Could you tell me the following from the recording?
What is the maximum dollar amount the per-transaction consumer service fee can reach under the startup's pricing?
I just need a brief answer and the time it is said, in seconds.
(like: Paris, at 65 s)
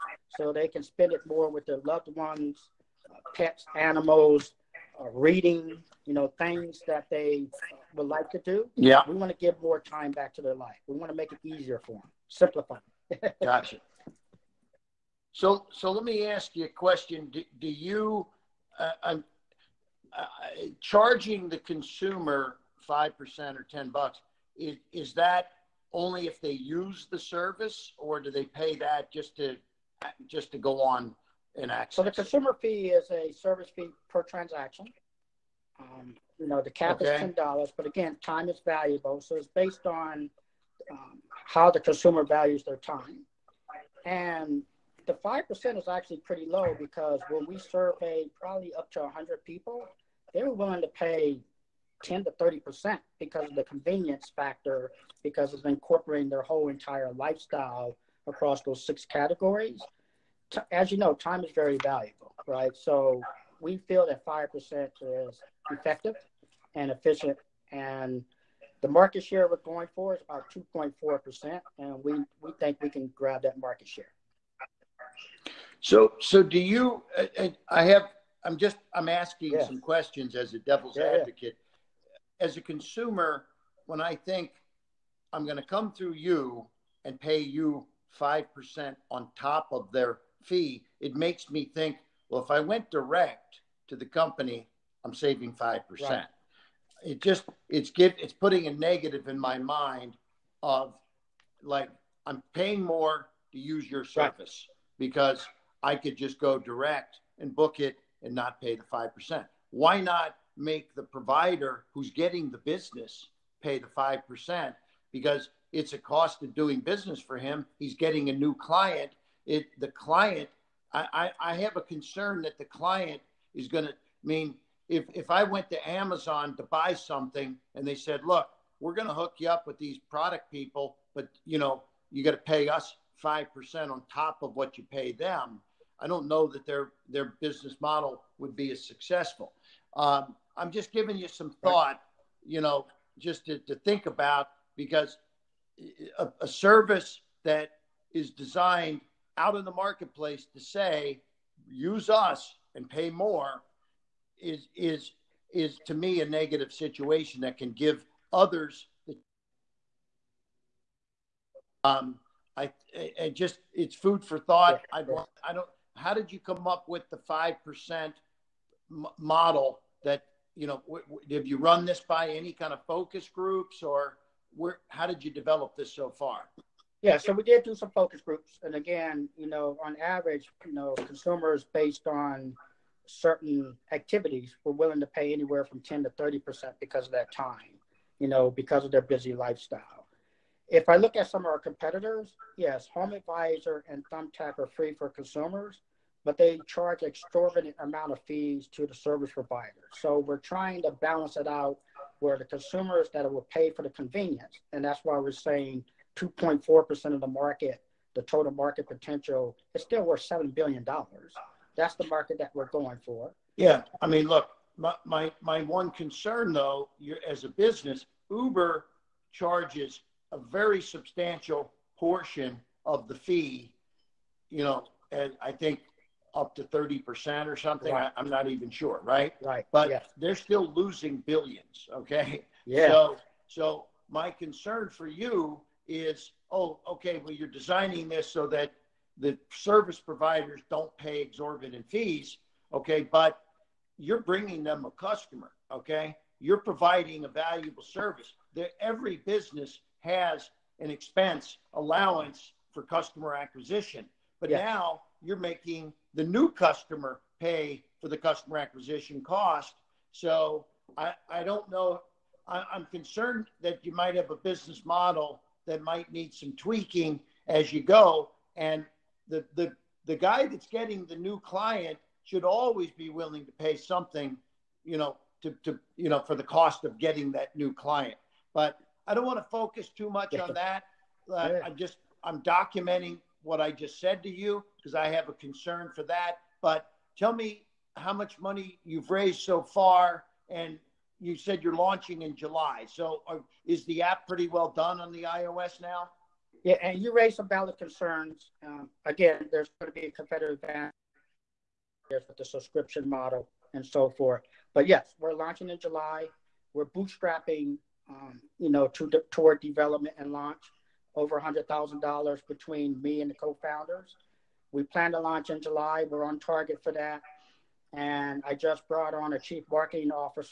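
$10, at 37 s.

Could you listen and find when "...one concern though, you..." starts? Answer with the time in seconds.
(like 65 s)
215 s.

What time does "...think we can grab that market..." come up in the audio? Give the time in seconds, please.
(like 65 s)
72 s.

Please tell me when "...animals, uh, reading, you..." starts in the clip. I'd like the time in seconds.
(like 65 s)
3 s.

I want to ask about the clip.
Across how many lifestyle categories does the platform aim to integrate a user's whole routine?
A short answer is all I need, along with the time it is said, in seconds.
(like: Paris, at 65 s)
6, at 58 s.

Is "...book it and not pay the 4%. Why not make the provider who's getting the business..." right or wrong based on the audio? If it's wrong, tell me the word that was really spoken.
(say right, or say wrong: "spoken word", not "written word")
wrong: "5", not "4".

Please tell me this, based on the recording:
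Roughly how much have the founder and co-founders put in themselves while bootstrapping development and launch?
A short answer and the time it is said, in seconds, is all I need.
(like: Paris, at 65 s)
over $100,000, at 311 s.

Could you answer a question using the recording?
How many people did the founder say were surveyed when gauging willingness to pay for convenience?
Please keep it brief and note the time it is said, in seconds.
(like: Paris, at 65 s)
100, at 49 s.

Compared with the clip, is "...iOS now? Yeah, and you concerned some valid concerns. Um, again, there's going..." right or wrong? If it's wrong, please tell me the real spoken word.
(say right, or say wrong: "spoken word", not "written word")
wrong: "raised", not "concerned".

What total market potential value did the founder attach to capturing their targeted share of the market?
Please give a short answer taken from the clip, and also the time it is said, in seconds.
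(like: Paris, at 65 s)
$7 billion, at 210 s.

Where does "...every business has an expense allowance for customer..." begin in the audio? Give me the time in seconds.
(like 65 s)
248 s.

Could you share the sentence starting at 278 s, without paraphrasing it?
But I don't want to focus too much on that.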